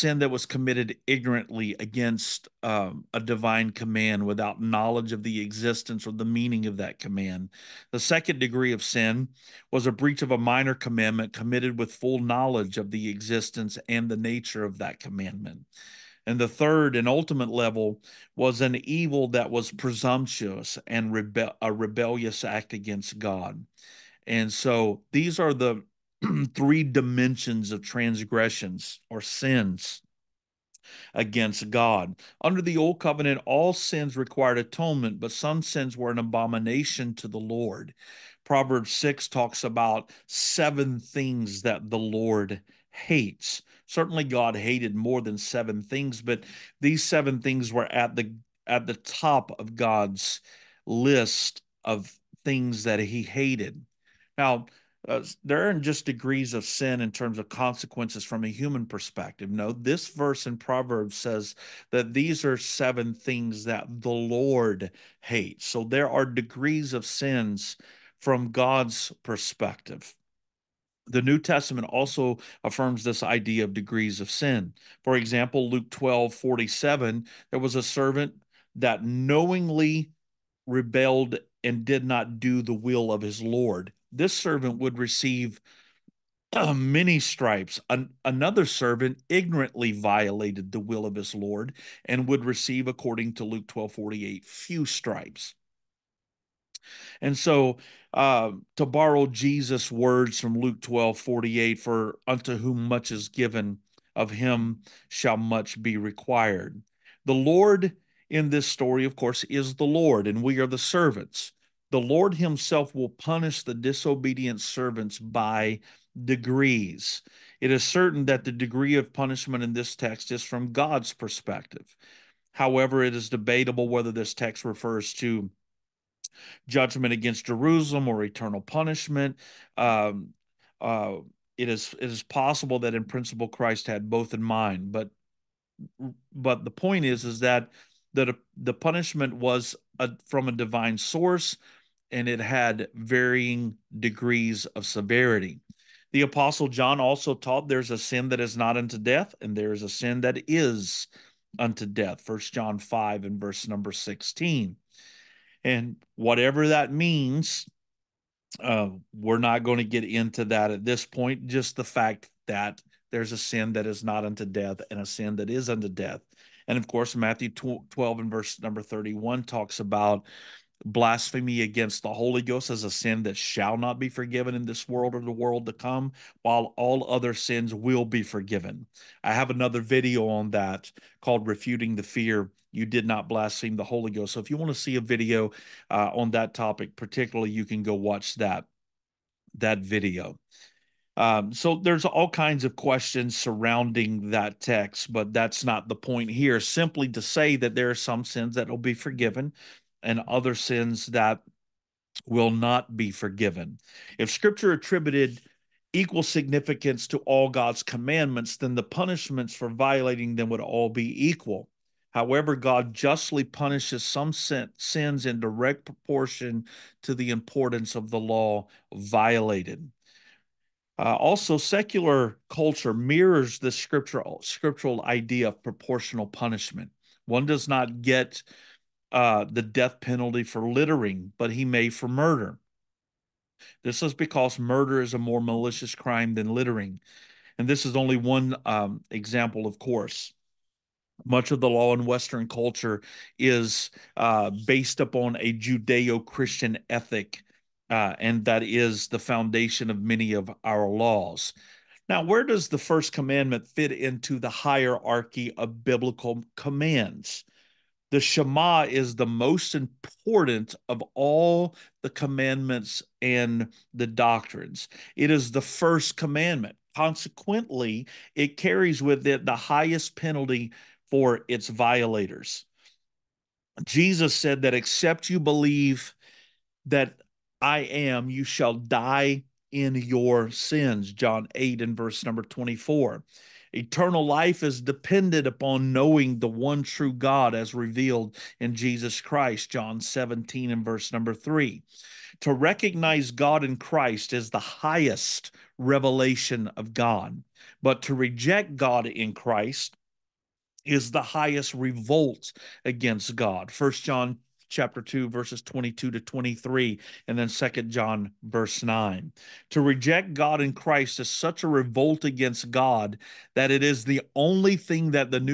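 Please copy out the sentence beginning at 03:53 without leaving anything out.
This is because murder is a more malicious crime than littering.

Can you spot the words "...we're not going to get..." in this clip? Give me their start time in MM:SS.
02:39.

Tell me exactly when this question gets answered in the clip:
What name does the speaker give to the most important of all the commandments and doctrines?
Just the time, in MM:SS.
04:18.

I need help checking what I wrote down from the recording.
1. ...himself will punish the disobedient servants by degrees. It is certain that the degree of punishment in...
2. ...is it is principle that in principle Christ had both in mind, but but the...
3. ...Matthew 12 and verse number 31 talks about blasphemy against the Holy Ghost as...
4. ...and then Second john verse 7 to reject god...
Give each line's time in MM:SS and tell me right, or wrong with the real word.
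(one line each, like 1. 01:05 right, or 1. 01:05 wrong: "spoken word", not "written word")
1. 01:52 right
2. 02:11 wrong: "possible", not "principle"
3. 02:47 right
4. 05:07 wrong: "9", not "7".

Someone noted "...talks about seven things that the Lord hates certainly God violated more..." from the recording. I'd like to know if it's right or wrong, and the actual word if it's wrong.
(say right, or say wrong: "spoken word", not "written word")
wrong: "hated", not "violated".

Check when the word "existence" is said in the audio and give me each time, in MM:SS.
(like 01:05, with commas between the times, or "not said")
00:05, 00:13.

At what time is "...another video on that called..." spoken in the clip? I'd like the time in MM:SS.
02:59.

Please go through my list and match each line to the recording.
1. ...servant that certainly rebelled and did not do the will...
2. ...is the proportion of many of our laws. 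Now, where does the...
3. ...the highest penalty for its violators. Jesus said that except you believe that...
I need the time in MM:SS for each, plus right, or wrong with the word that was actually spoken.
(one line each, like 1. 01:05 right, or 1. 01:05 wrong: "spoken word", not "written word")
1. 01:17 wrong: "knowingly", not "certainly"
2. 04:08 wrong: "foundation", not "proportion"
3. 04:29 right.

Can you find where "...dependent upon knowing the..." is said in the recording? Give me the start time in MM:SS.
04:44.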